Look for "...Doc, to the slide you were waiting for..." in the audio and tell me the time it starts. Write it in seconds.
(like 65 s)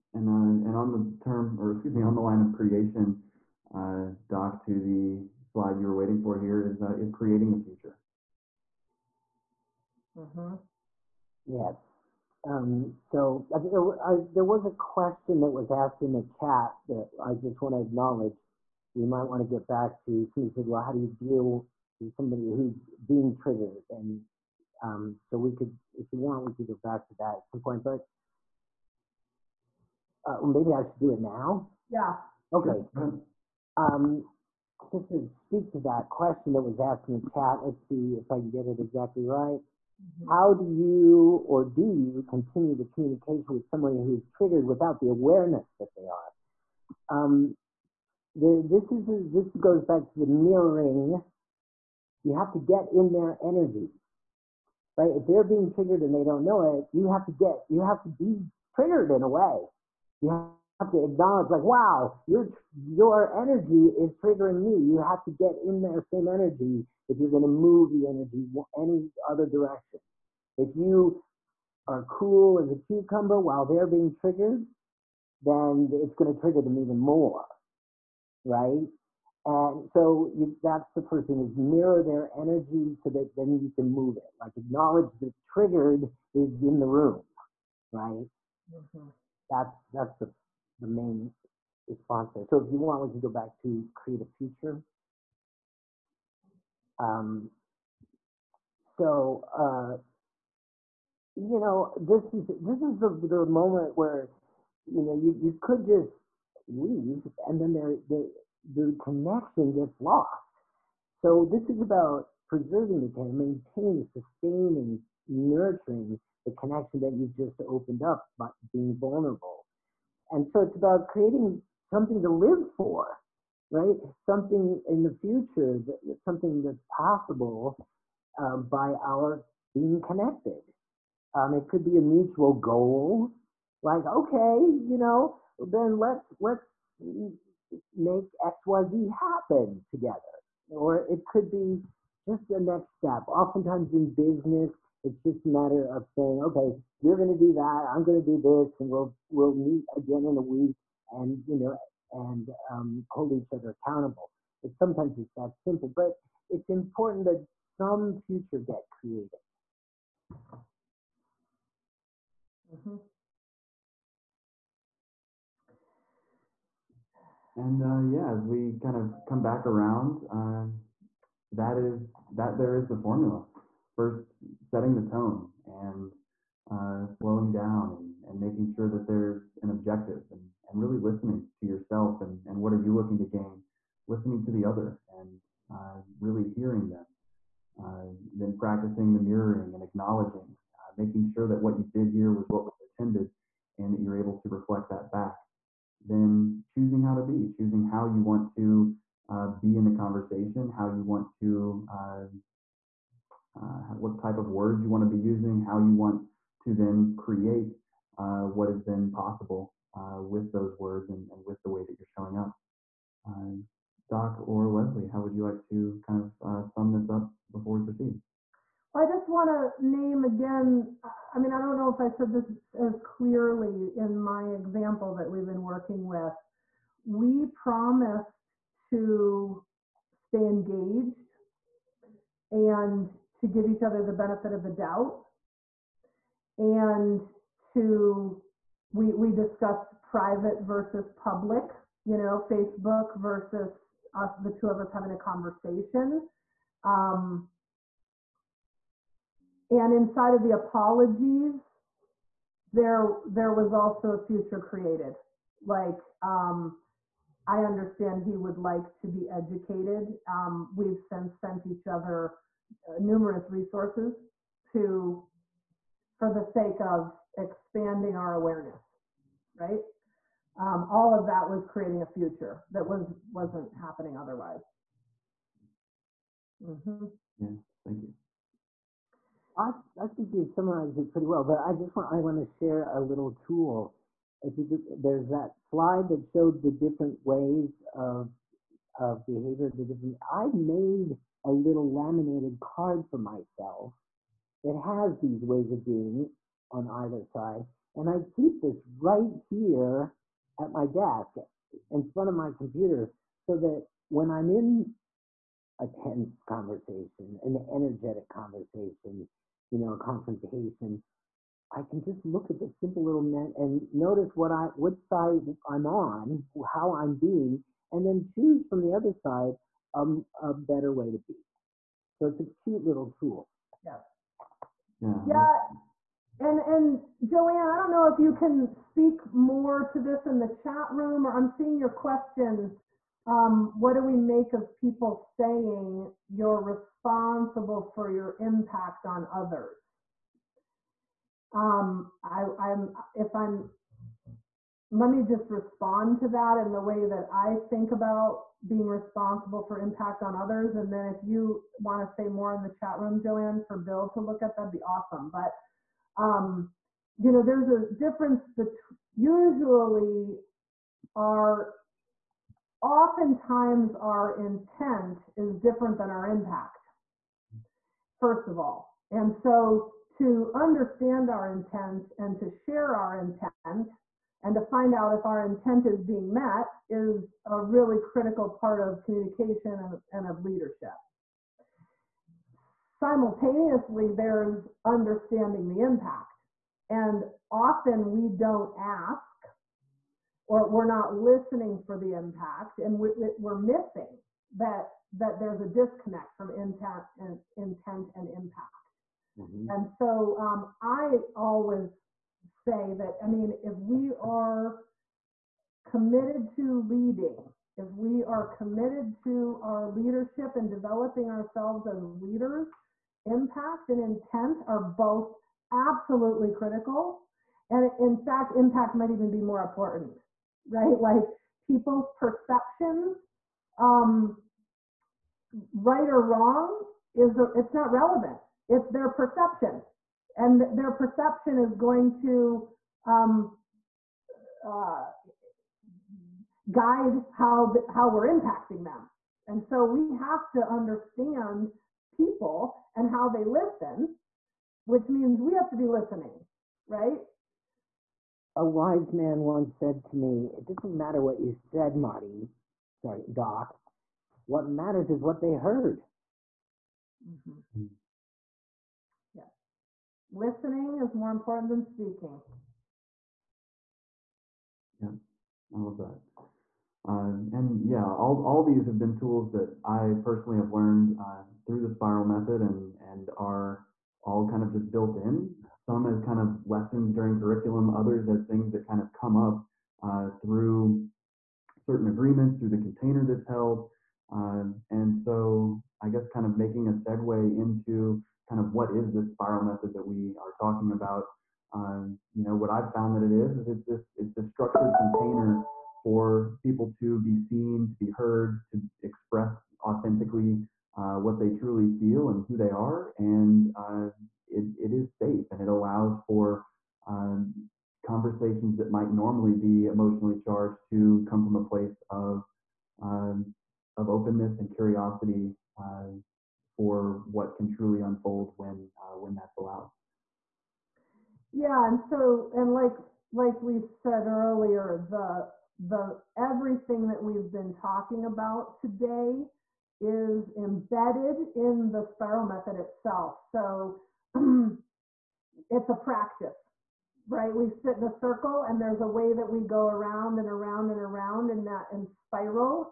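4 s.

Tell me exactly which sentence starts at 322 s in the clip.
So it's a cute little tool.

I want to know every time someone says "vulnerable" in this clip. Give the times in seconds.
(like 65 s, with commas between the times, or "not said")
118 s.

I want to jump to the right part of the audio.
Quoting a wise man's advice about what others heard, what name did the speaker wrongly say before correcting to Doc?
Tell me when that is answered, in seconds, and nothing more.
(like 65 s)
451 s.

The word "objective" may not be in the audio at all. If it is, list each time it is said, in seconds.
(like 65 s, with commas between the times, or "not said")
179 s.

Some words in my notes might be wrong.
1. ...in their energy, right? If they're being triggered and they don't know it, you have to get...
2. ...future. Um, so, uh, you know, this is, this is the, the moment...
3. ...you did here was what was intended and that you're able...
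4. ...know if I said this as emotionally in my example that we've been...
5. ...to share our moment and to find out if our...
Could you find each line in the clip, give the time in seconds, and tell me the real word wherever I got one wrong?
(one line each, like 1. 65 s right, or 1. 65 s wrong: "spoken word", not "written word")
1. 52 s right
2. 94 s right
3. 191 s right
4. 221 s wrong: "clearly", not "emotionally"
5. 372 s wrong: "intent", not "moment".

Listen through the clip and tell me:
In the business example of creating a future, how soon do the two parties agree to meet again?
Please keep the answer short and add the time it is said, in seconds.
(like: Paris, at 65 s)
A week, at 150 s.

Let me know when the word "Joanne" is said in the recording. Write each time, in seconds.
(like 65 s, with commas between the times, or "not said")
327 s, 353 s.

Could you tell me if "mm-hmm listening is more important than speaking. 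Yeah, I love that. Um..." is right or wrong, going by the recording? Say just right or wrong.
right.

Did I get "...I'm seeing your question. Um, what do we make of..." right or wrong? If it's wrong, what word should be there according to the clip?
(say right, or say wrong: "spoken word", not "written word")
right.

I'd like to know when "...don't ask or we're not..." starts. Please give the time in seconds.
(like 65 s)
388 s.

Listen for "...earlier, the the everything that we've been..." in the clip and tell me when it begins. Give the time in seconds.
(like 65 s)
524 s.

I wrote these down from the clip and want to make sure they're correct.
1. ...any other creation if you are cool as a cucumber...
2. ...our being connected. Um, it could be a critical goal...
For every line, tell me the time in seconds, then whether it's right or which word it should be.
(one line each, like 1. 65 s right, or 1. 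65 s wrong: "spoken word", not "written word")
1. 68 s wrong: "direction", not "creation"
2. 129 s wrong: "mutual", not "critical".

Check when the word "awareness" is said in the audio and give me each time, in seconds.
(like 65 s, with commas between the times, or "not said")
45 s, 268 s.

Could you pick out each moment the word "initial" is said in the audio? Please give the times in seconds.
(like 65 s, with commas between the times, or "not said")
not said.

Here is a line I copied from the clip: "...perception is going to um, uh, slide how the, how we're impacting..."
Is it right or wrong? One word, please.
wrong.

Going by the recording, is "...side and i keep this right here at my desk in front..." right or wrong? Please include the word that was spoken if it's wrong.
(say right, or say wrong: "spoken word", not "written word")
right.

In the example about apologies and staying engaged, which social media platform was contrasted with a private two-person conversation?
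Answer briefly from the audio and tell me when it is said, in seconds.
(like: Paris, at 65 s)
Facebook, at 242 s.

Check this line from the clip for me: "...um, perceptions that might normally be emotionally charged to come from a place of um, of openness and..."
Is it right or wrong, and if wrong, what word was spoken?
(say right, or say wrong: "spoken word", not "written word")
wrong: "conversations", not "perceptions".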